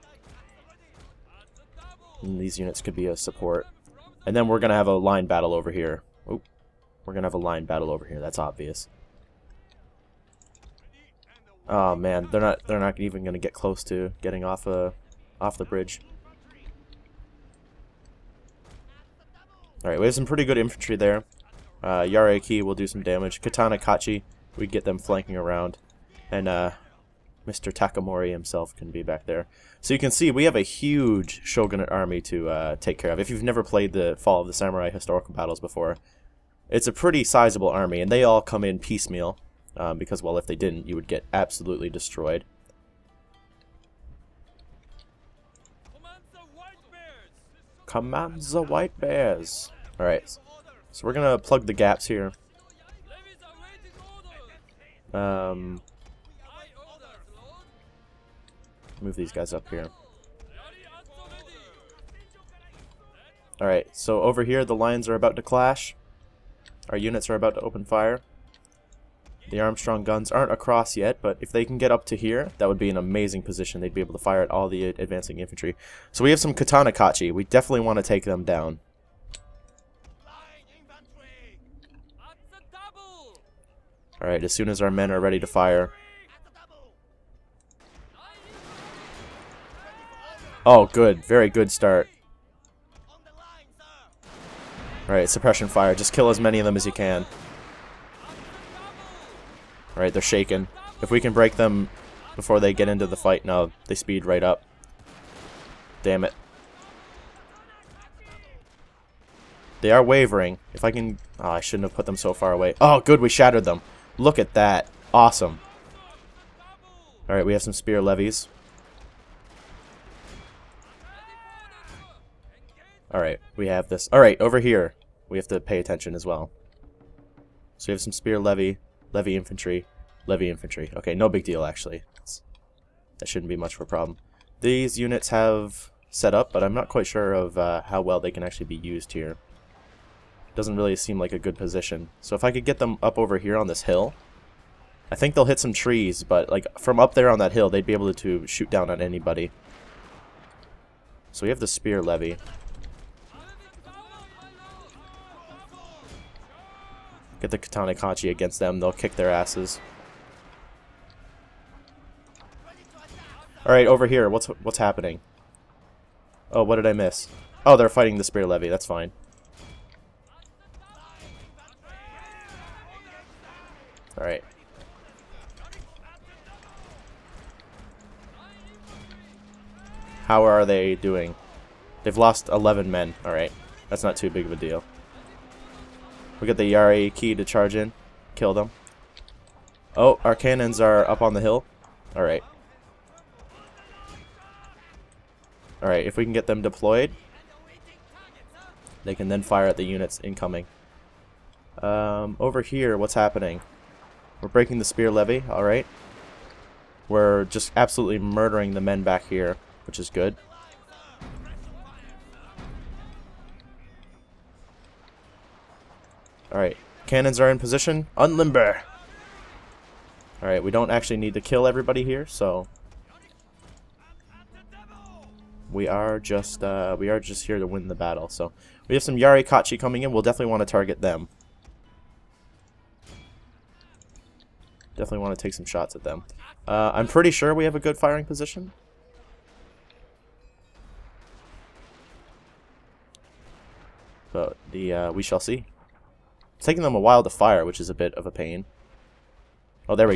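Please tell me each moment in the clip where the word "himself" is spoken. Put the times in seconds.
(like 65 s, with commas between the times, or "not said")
28 s.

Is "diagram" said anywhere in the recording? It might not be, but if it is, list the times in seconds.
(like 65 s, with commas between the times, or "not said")
not said.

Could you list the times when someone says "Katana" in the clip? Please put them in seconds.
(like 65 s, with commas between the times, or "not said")
23 s, 76 s, 157 s.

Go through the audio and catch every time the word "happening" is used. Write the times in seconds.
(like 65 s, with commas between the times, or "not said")
164 s, 203 s.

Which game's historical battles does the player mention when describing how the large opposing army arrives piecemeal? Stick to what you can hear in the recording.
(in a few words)
Fall of the Samurai.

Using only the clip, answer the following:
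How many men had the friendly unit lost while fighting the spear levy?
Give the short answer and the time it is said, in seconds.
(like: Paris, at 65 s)
11, at 182 s.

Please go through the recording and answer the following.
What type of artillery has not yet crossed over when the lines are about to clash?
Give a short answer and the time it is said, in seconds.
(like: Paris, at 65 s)
Armstrong guns, at 69 s.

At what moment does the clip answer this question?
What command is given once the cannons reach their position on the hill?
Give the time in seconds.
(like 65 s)
218 s.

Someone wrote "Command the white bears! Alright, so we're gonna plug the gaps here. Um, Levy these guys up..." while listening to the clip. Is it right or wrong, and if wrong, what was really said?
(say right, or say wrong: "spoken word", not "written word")
wrong: "Move", not "Levy".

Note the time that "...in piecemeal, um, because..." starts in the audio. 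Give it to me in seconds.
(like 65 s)
38 s.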